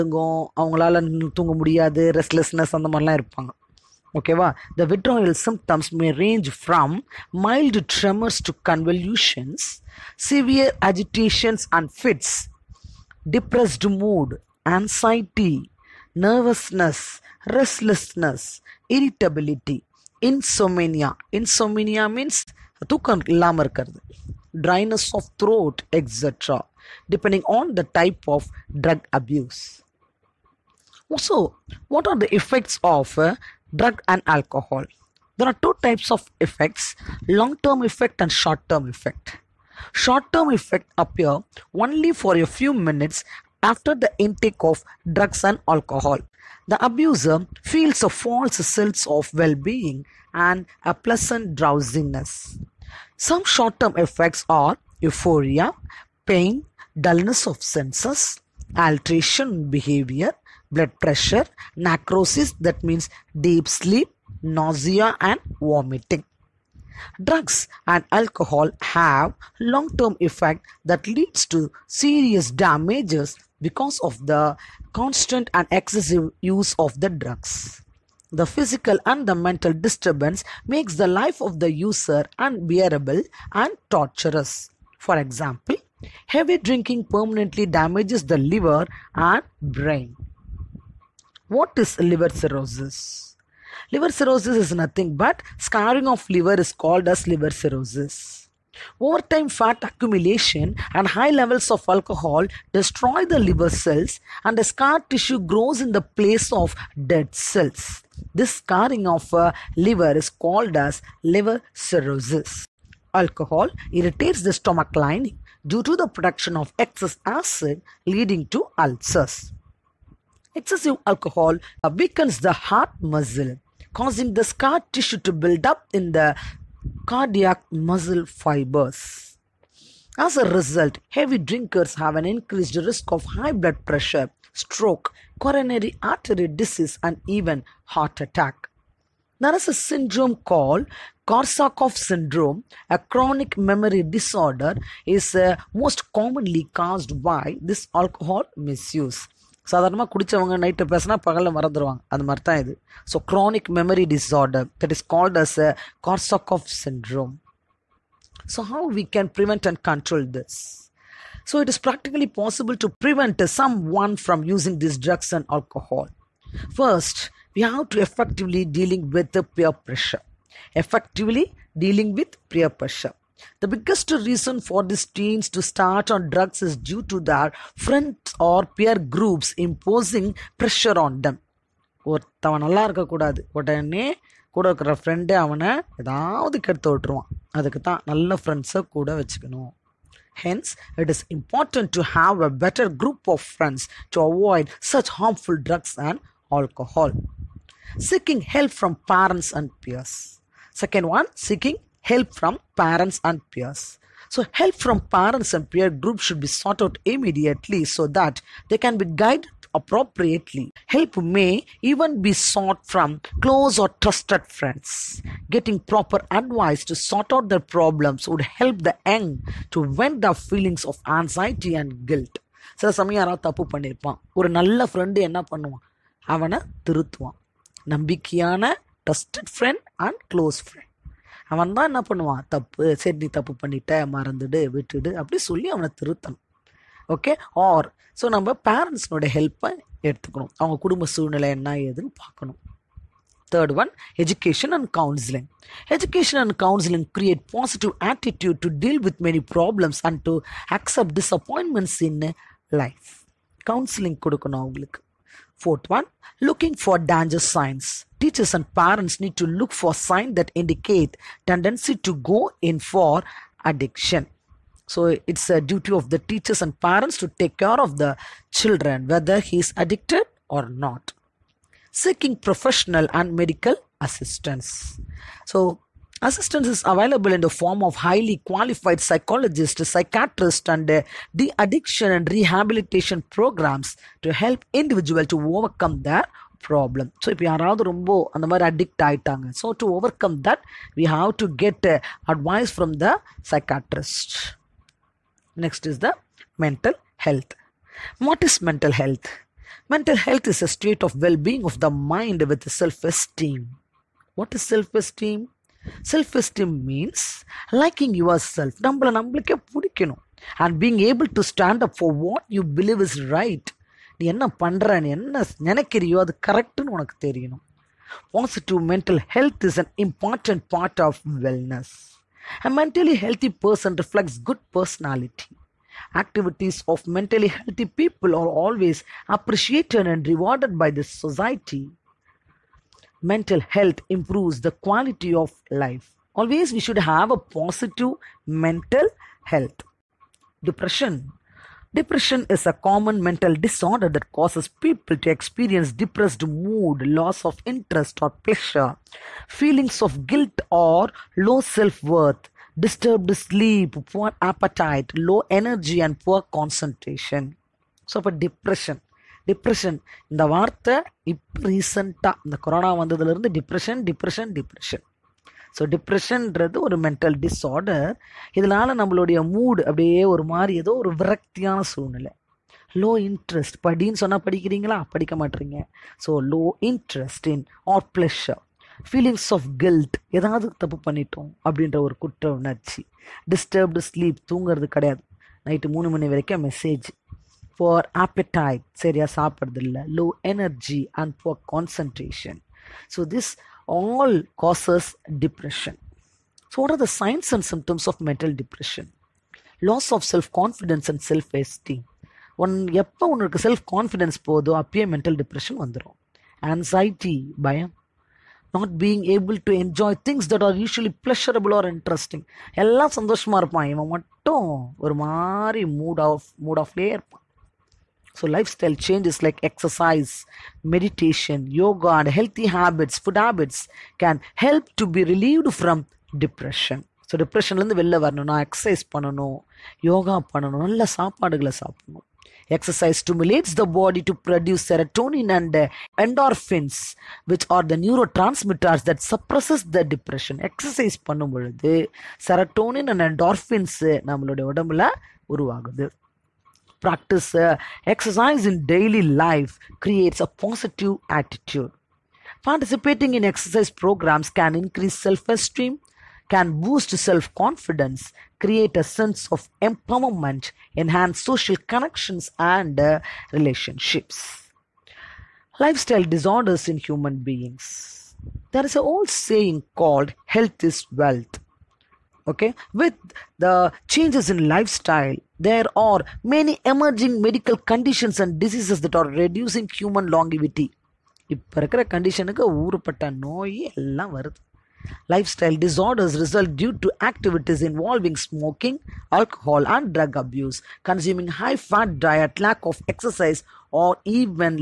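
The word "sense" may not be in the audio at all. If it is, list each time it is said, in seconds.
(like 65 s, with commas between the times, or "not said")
48 s, 57 s, 459 s.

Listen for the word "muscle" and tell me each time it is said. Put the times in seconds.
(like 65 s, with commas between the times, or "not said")
123 s, 127 s.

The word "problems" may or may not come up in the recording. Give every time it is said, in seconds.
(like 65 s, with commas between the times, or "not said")
217 s, 286 s.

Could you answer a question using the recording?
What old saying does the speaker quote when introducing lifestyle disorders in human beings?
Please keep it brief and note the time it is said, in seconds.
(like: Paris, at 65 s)
Health is wealth, at 470 s.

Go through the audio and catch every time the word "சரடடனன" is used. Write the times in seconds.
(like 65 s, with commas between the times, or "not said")
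434 s, 442 s.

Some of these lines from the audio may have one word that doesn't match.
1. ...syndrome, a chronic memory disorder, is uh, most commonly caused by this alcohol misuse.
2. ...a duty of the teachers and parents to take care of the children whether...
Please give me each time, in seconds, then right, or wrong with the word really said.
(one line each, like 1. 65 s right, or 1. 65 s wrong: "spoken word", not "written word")
1. 141 s right
2. 265 s right.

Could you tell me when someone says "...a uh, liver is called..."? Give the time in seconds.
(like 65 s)
109 s.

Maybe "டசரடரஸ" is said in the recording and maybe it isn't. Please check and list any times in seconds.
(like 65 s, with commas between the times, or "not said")
485 s.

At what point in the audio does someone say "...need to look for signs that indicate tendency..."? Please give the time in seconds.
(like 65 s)
259 s.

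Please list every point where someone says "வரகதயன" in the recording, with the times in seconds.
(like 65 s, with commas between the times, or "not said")
371 s.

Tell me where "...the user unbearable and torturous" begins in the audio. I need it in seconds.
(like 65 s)
81 s.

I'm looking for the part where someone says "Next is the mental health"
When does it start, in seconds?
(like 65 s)
295 s.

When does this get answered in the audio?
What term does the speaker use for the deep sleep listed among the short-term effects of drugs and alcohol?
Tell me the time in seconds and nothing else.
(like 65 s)
61 s.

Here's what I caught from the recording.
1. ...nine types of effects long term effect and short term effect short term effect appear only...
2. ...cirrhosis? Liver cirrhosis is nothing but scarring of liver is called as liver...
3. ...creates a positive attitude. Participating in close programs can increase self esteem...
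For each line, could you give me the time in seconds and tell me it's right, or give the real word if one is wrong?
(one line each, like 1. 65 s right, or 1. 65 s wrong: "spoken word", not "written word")
1. 35 s wrong: "two", not "nine"
2. 92 s right
3. 450 s wrong: "exercise", not "close".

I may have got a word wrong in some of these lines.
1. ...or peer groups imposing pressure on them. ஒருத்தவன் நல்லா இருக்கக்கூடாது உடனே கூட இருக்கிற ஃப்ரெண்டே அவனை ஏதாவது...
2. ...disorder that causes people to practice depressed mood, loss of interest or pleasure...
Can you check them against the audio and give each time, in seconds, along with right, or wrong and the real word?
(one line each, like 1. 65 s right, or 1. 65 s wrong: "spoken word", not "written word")
1. 178 s right
2. 343 s wrong: "experience", not "practice".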